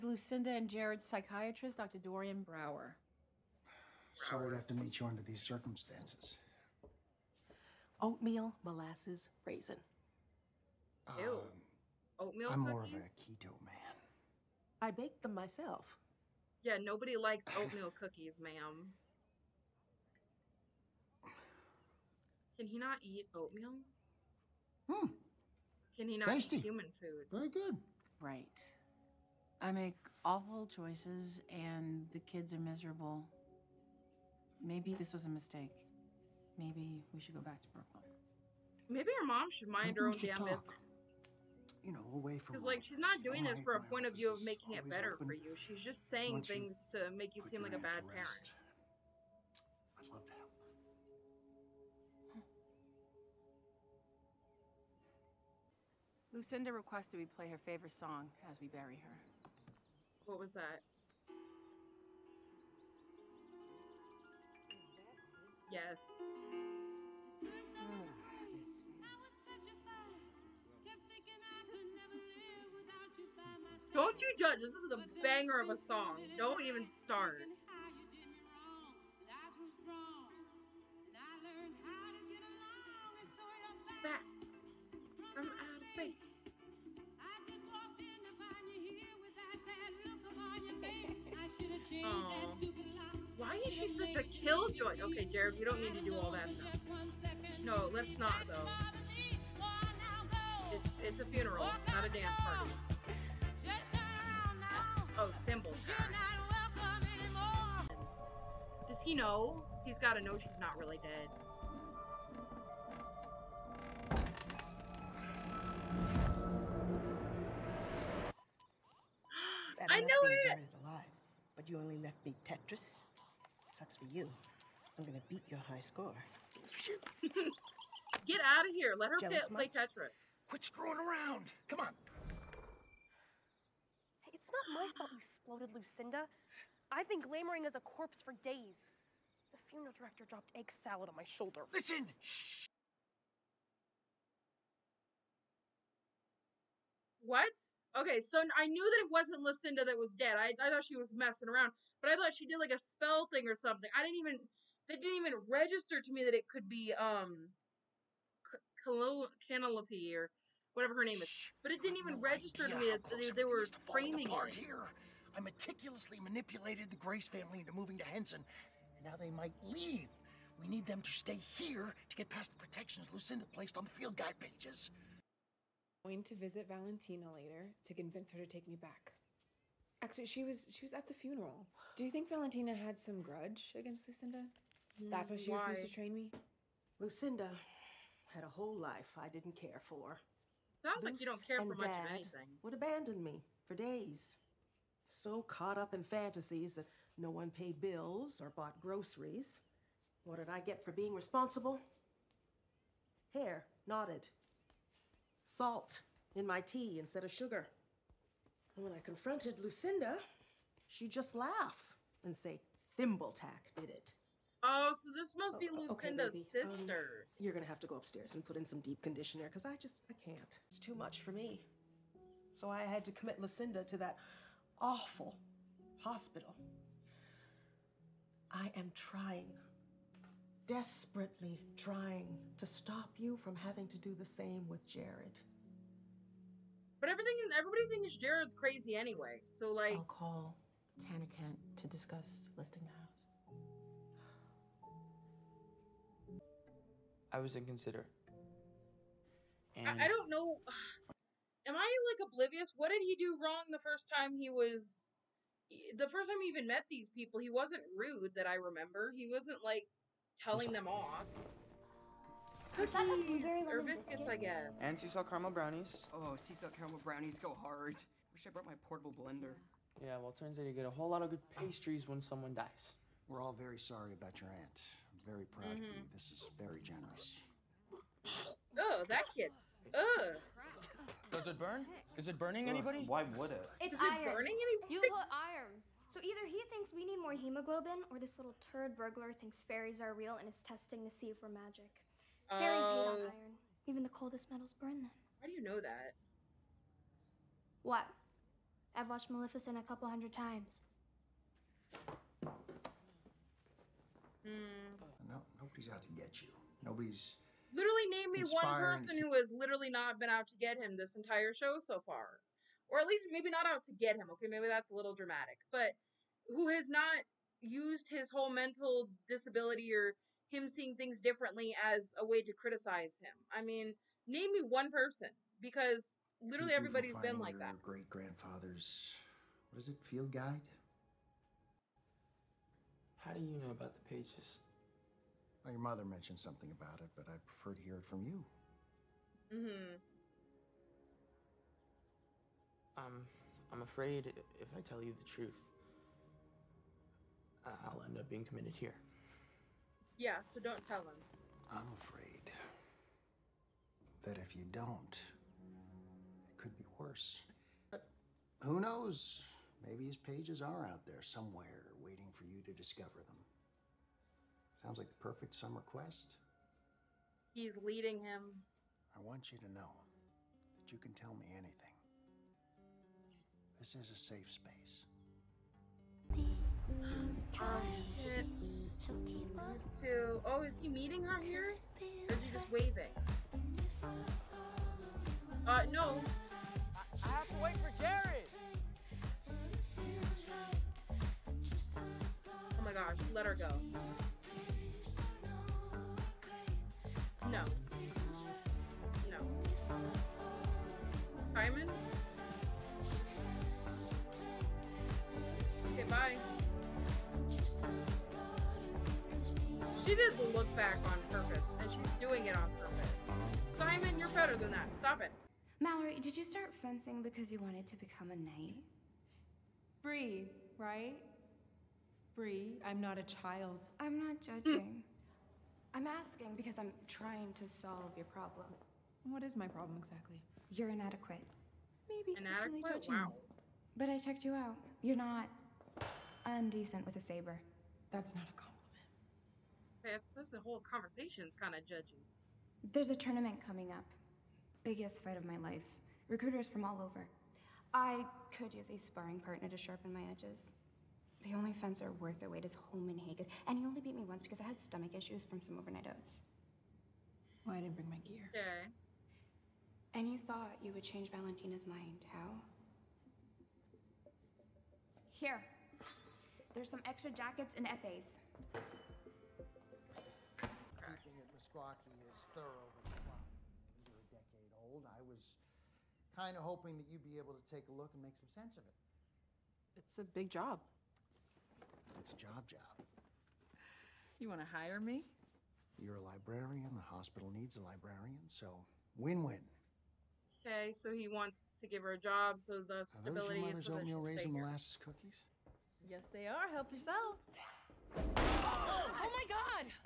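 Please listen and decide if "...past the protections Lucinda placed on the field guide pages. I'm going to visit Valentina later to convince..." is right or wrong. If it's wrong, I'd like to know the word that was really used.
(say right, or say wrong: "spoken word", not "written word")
right.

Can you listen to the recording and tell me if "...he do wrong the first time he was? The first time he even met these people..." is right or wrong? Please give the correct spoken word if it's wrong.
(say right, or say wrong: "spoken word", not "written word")
right.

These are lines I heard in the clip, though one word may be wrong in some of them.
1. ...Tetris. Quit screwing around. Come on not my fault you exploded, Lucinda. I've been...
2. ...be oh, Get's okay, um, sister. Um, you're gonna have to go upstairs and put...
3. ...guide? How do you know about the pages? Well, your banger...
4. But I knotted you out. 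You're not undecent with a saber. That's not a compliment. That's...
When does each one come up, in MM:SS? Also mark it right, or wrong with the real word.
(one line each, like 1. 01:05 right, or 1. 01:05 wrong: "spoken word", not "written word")
1. 02:09 right
2. 03:35 wrong: "Lucinda", not "Get"
3. 05:30 wrong: "mother", not "banger"
4. 07:13 wrong: "checked", not "knotted".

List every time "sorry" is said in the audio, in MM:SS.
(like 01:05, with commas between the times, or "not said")
00:04, 04:33.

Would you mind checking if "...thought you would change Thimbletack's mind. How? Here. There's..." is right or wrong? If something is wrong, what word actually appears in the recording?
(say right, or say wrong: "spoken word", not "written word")
wrong: "Valentina", not "Thimbletack".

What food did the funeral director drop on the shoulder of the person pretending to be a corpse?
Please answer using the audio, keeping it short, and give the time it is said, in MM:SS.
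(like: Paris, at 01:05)
Egg salad, at 02:20.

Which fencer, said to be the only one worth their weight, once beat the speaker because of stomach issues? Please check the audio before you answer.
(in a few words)
Holman Hagen.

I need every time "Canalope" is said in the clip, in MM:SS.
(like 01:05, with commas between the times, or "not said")
02:38.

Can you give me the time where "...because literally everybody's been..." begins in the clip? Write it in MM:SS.
05:25.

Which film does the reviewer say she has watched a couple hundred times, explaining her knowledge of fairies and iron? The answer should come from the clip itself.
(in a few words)
Maleficent.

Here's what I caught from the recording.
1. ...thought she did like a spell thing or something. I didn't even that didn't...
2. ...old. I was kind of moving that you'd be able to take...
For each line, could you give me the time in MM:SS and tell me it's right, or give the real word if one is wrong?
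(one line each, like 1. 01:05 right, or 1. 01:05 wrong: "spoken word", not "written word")
1. 02:32 right
2. 07:54 wrong: "hoping", not "moving".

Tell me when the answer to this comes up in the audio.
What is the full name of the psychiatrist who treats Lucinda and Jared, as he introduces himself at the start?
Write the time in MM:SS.
00:01.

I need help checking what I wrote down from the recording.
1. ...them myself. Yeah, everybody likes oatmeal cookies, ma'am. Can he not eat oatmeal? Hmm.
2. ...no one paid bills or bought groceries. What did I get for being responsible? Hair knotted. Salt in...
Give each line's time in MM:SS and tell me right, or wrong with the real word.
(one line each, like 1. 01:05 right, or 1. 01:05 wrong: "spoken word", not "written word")
1. 00:15 wrong: "nobody", not "everybody"
2. 03:17 right.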